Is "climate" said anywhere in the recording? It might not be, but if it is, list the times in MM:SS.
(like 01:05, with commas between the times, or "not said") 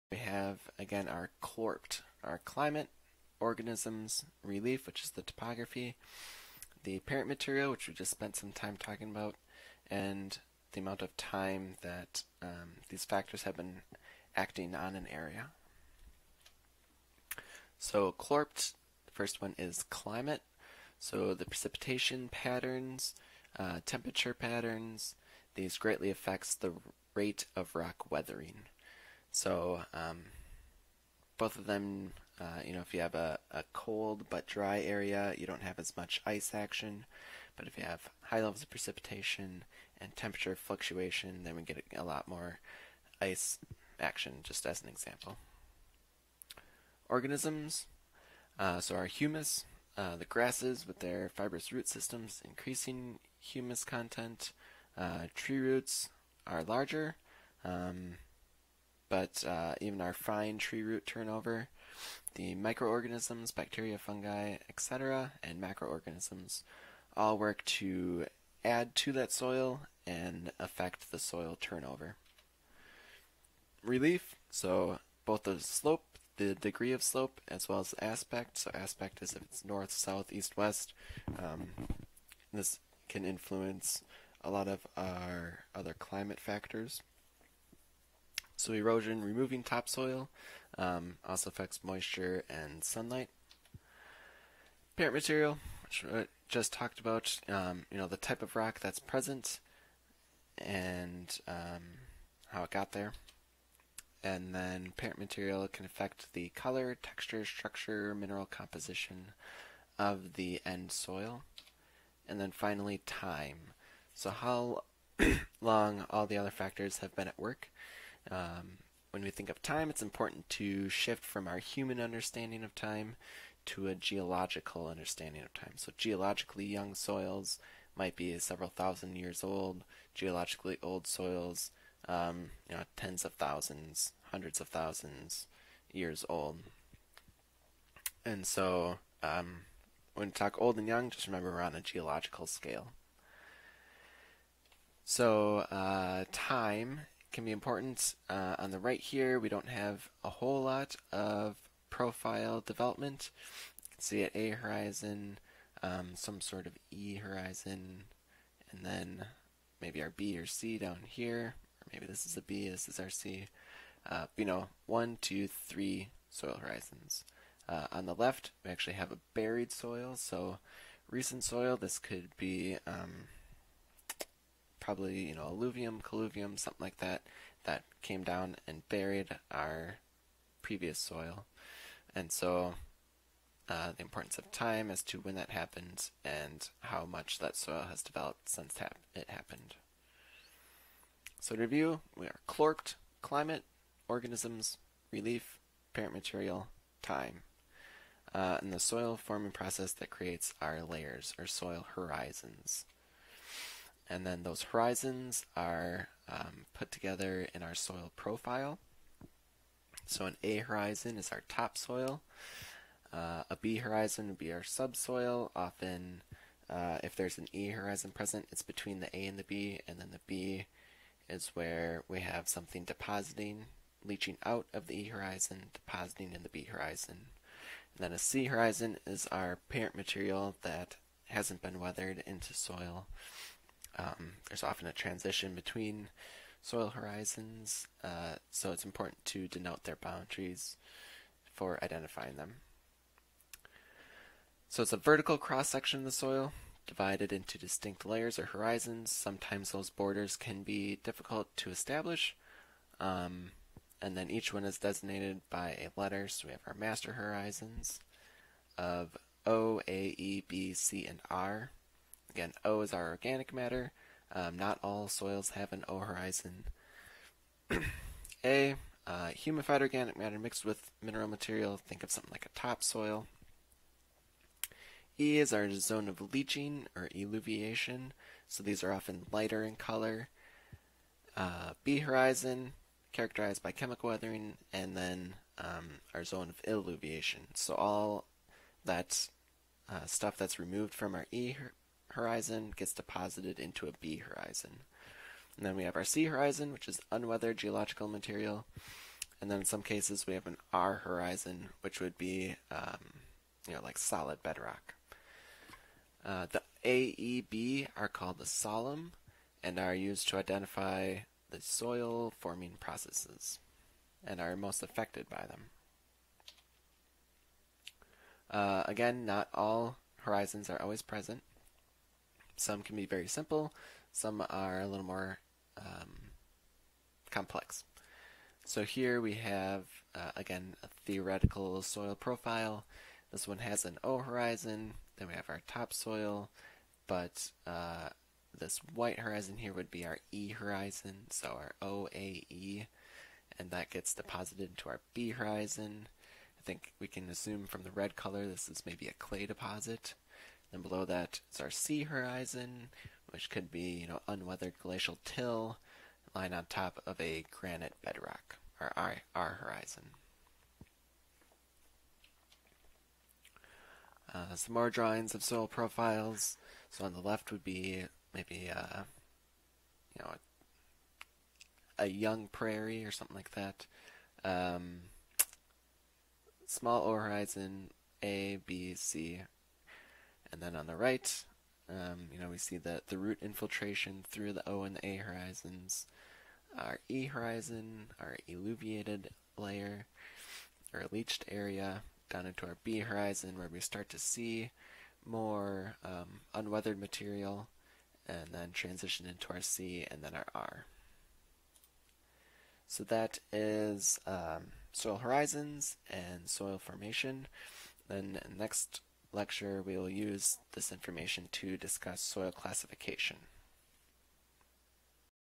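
00:02, 00:19, 01:25, 03:13.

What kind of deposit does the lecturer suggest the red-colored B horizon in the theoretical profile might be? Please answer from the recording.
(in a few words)
A clay deposit.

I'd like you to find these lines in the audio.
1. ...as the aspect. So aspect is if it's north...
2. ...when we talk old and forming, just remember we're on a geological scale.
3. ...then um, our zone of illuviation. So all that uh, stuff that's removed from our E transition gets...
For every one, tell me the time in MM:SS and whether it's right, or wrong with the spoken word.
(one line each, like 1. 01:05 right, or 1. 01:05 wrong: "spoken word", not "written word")
1. 01:17 right
2. 02:20 wrong: "young", not "forming"
3. 04:44 wrong: "horizon", not "transition".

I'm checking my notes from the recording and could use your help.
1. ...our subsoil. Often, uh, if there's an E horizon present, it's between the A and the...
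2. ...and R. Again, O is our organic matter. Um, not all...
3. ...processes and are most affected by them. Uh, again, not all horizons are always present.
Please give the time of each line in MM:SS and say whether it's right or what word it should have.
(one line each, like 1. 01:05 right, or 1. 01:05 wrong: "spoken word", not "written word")
1. 03:34 right
2. 04:21 right
3. 05:12 right.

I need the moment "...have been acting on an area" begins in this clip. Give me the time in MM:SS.
00:13.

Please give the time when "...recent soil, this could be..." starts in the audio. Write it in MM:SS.
02:51.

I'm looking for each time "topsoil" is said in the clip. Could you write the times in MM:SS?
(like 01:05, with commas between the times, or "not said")
01:29, 03:31, 04:32, 05:35.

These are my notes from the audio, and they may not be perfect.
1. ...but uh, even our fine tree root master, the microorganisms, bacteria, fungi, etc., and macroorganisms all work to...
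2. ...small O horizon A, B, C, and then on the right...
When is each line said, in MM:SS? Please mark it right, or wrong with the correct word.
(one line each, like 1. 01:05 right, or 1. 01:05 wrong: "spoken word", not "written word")
1. 00:59 wrong: "turnover", not "master"
2. 06:16 right.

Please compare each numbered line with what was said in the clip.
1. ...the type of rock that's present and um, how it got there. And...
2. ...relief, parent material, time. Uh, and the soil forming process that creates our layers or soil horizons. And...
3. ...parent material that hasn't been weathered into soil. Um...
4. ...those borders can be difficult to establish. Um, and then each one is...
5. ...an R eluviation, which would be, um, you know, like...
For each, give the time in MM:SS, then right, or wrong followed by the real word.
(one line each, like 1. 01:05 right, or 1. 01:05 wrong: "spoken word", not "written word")
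1. 01:38 right
2. 03:15 right
3. 03:49 right
4. 04:09 right
5. 05:00 wrong: "horizon", not "eluviation".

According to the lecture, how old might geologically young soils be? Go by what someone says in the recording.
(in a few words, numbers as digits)
Several thousand years.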